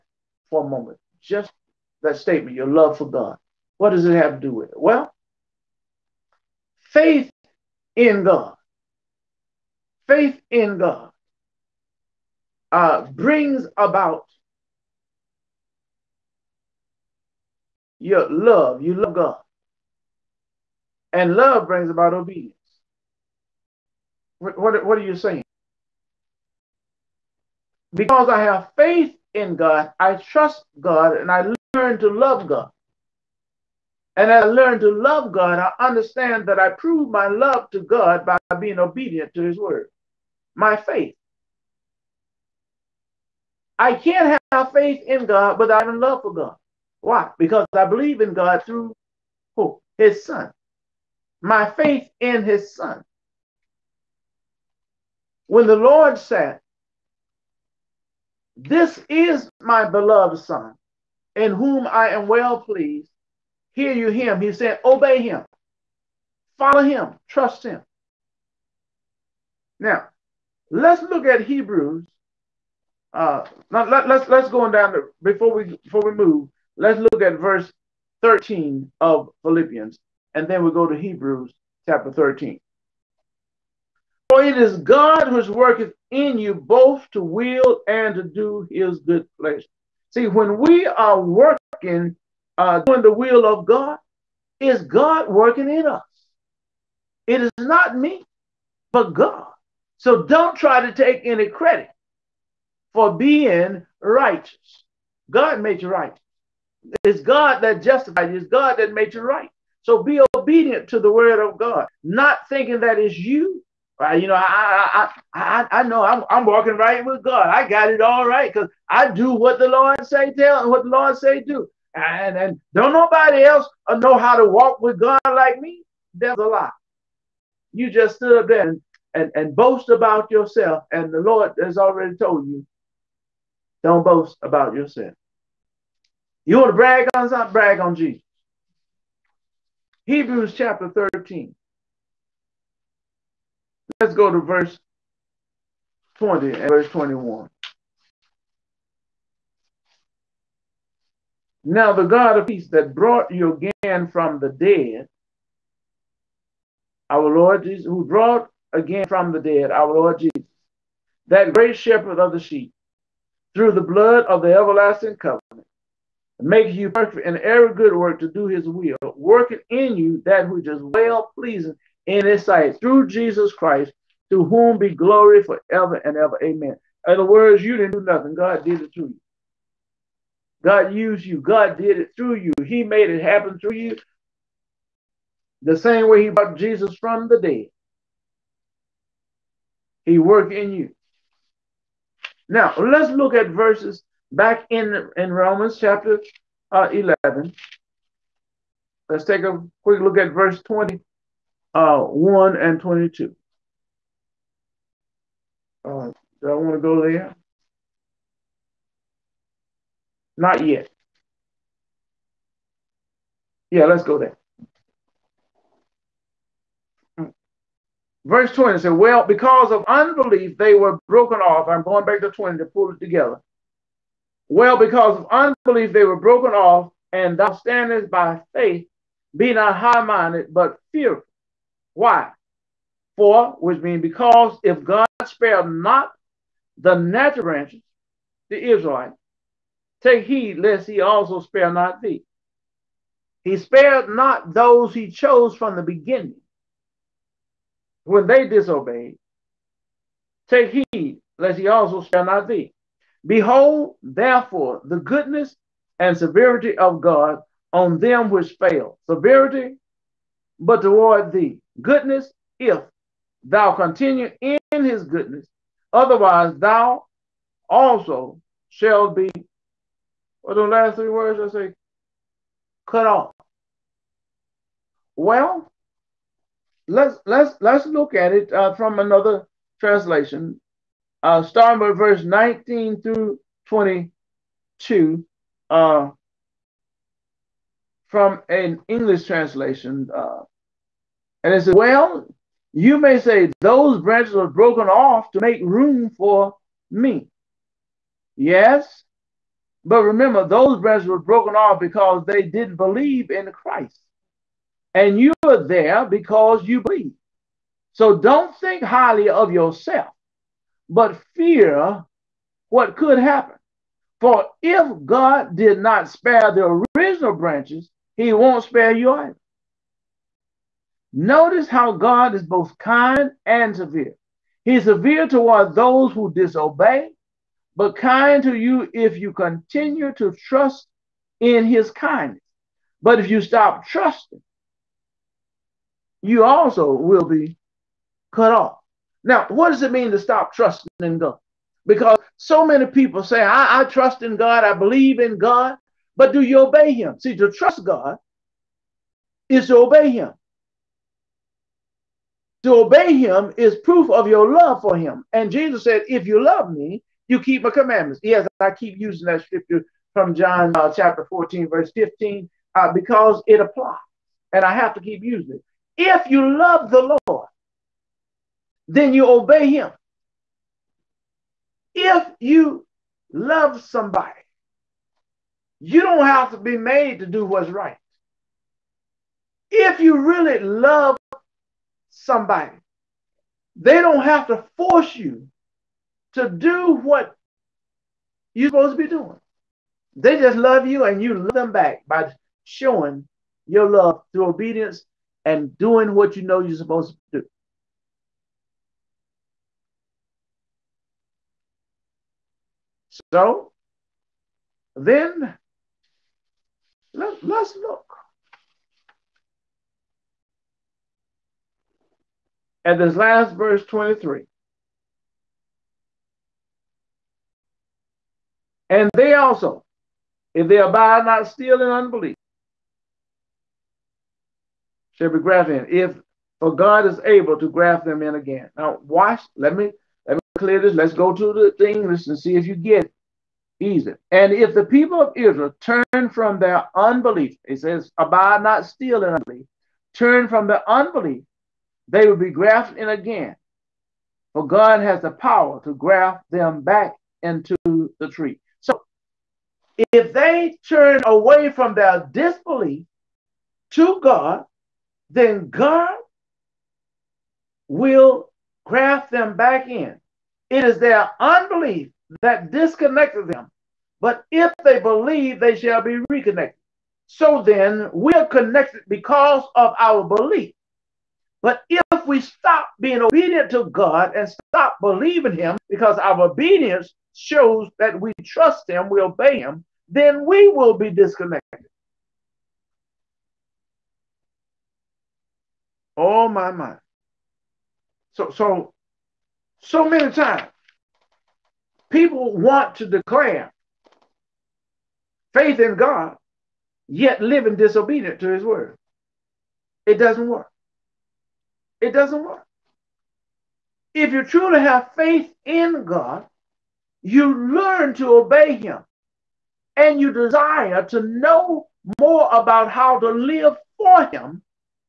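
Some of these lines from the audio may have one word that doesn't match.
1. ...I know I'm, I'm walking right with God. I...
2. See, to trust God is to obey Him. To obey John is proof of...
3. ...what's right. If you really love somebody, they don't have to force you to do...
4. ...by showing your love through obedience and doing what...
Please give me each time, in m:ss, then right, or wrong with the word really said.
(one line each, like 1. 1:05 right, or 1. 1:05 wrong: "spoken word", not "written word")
1. 1:55 right
2. 5:47 wrong: "Him", not "John"
3. 6:17 right
4. 6:32 right.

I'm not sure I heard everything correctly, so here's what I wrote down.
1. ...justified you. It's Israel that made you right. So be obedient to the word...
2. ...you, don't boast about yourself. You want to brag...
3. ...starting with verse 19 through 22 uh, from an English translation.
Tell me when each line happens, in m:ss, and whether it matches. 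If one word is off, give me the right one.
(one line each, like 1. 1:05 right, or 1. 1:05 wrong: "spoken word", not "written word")
1. 1:47 wrong: "God", not "Israel"
2. 2:12 right
3. 4:41 right.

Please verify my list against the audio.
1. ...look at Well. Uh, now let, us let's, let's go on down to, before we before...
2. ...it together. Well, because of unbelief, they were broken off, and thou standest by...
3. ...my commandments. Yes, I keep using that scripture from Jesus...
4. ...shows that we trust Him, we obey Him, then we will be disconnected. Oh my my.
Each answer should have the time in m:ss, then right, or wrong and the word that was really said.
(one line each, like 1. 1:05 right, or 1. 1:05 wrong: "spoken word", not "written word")
1. 1:11 wrong: "Hebrews", not "Well"
2. 3:42 right
3. 5:57 wrong: "John", not "Jesus"
4. 7:57 right.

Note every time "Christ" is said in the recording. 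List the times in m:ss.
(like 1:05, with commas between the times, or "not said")
2:53, 5:03.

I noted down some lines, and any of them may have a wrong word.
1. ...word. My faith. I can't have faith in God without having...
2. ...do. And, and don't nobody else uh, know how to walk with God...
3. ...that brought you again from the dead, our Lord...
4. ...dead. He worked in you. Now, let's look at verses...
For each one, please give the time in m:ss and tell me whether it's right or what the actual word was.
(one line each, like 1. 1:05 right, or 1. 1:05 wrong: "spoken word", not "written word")
1. 0:39 right
2. 2:01 right
3. 2:32 right
4. 3:07 right.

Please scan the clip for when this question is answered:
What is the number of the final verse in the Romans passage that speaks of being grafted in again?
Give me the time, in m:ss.
6:53.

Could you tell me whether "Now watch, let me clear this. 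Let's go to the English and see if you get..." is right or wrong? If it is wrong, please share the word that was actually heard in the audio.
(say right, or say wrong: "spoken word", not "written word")
right.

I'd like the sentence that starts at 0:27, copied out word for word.
Because I have faith in God, I trust God, and I learn to love God.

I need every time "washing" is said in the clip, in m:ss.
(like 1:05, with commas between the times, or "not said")
not said.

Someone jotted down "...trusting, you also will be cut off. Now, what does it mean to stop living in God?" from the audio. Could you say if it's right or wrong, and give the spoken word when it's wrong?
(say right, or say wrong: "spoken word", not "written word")
wrong: "trusting", not "living".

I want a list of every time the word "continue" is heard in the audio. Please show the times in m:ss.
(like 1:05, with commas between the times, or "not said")
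4:23, 5:29.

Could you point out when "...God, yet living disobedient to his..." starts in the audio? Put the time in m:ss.
8:15.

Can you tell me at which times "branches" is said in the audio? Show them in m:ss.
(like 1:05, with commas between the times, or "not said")
3:57, 4:54, 5:00, 5:17.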